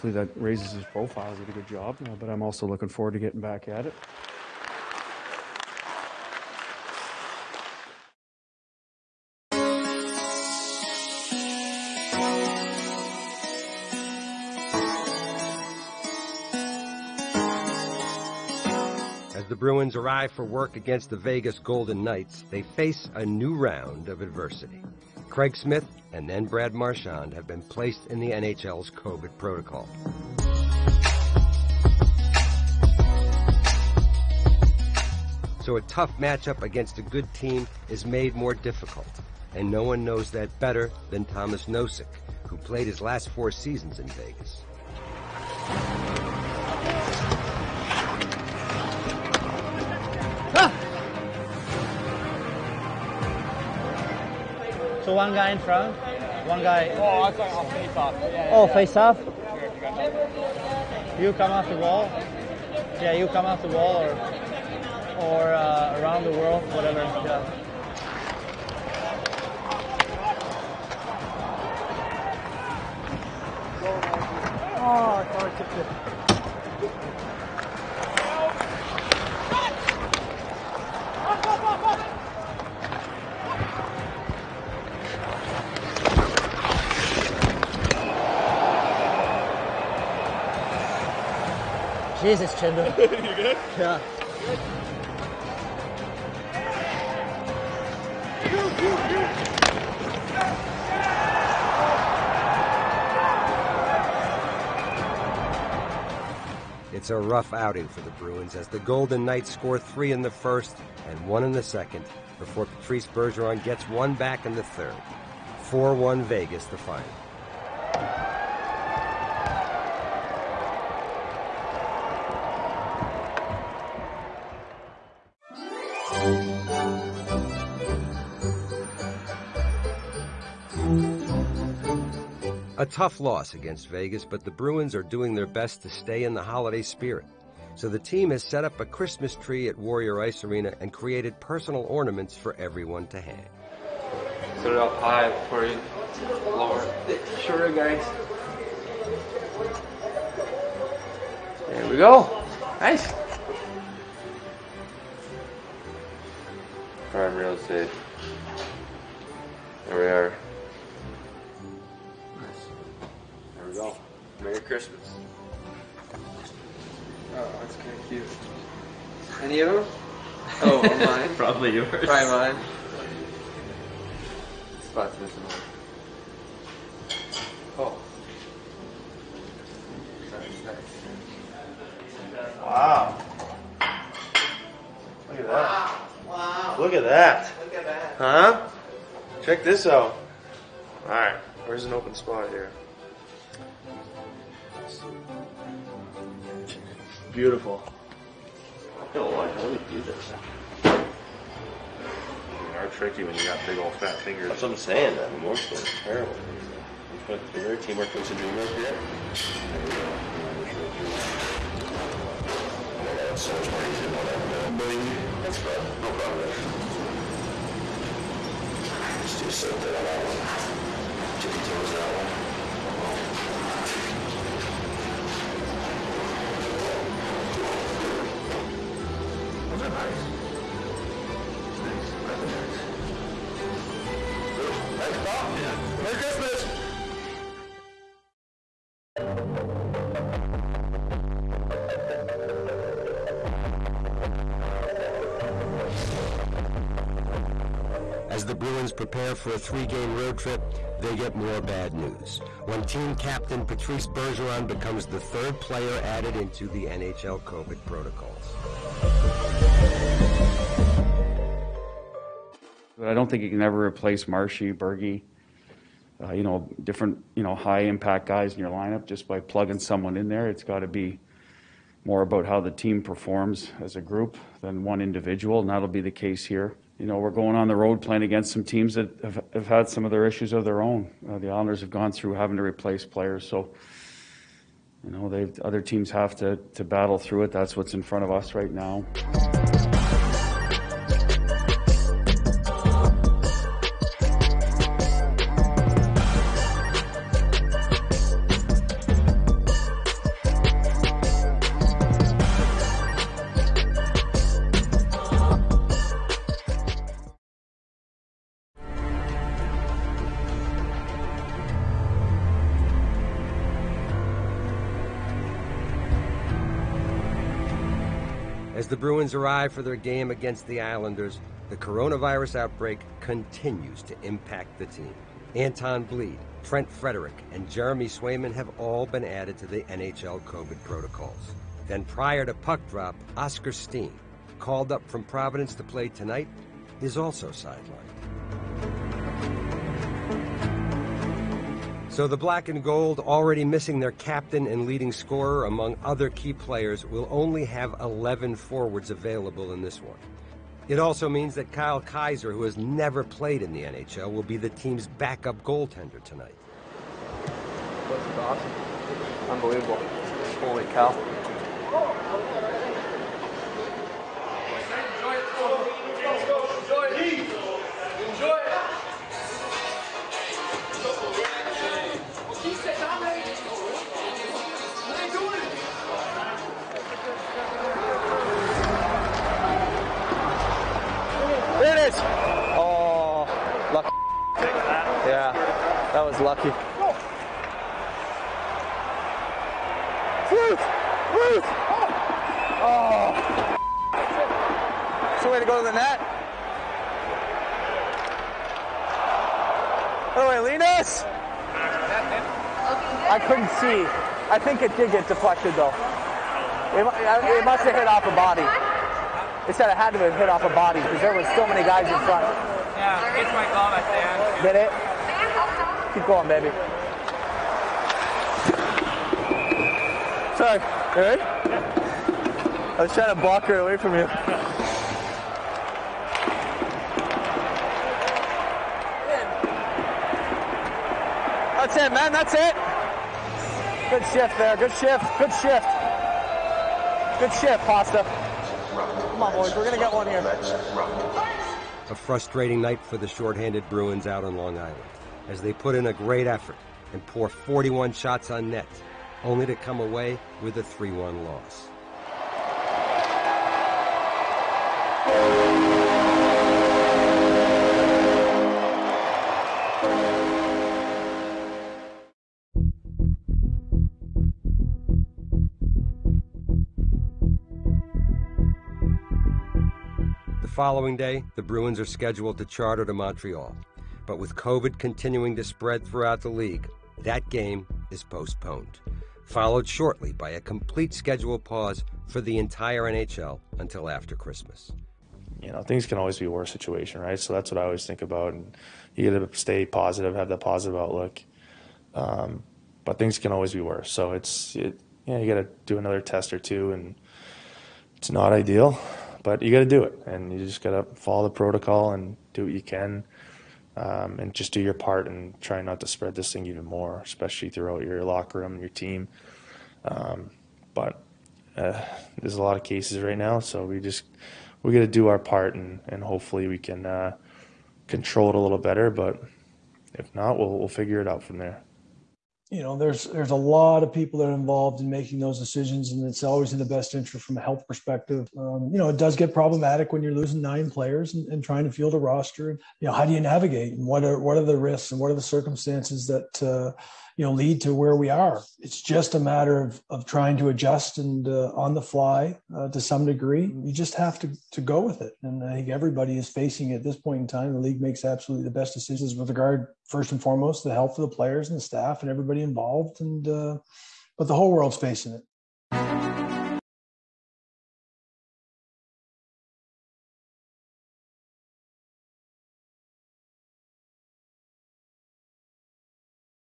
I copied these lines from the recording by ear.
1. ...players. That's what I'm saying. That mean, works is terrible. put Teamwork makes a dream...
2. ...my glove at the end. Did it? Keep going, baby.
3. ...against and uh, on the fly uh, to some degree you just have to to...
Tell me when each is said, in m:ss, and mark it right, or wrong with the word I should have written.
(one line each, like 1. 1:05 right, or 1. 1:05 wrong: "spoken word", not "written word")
1. 3:24 wrong: "fingers", not "players"
2. 6:53 right
3. 9:00 wrong: "adjust", not "against".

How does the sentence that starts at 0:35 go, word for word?
So a tough matchup against a good team is made more difficult.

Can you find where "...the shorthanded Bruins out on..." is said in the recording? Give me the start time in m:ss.
7:23.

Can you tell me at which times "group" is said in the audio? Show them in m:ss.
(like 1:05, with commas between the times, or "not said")
4:34.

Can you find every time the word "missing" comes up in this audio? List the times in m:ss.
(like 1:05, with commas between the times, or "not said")
2:55, 5:43.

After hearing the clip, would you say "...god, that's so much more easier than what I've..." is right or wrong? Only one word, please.
right.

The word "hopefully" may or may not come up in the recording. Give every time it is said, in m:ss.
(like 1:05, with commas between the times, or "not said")
8:36.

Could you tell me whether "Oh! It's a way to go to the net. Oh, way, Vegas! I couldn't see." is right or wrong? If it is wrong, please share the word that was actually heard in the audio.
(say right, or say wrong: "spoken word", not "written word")
wrong: "Linus", not "Vegas".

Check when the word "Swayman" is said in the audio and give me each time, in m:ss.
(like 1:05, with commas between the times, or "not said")
5:28.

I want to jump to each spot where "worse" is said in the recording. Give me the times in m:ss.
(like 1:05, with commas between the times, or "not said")
8:06, 8:13.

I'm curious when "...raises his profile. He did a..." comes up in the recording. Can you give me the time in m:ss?
0:00.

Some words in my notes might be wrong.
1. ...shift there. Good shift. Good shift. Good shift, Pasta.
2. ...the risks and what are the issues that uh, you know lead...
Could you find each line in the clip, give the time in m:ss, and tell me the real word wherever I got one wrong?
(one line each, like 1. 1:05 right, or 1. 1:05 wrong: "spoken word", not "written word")
1. 7:14 right
2. 8:54 wrong: "circumstances", not "issues".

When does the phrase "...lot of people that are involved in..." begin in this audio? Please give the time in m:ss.
8:43.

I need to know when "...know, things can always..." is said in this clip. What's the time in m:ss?
8:05.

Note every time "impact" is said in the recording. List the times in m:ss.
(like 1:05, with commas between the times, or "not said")
4:27, 5:24.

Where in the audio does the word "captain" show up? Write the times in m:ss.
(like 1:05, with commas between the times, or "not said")
4:13, 5:44.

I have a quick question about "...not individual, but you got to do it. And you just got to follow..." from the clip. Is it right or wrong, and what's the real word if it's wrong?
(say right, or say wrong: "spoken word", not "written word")
wrong: "ideal", not "individual".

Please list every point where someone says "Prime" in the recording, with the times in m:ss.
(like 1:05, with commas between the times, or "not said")
2:37.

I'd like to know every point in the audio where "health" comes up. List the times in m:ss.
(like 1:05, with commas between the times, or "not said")
8:47, 9:10.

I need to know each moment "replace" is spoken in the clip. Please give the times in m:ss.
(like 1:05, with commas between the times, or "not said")
4:23, 4:42.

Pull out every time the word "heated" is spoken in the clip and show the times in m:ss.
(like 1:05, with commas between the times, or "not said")
not said.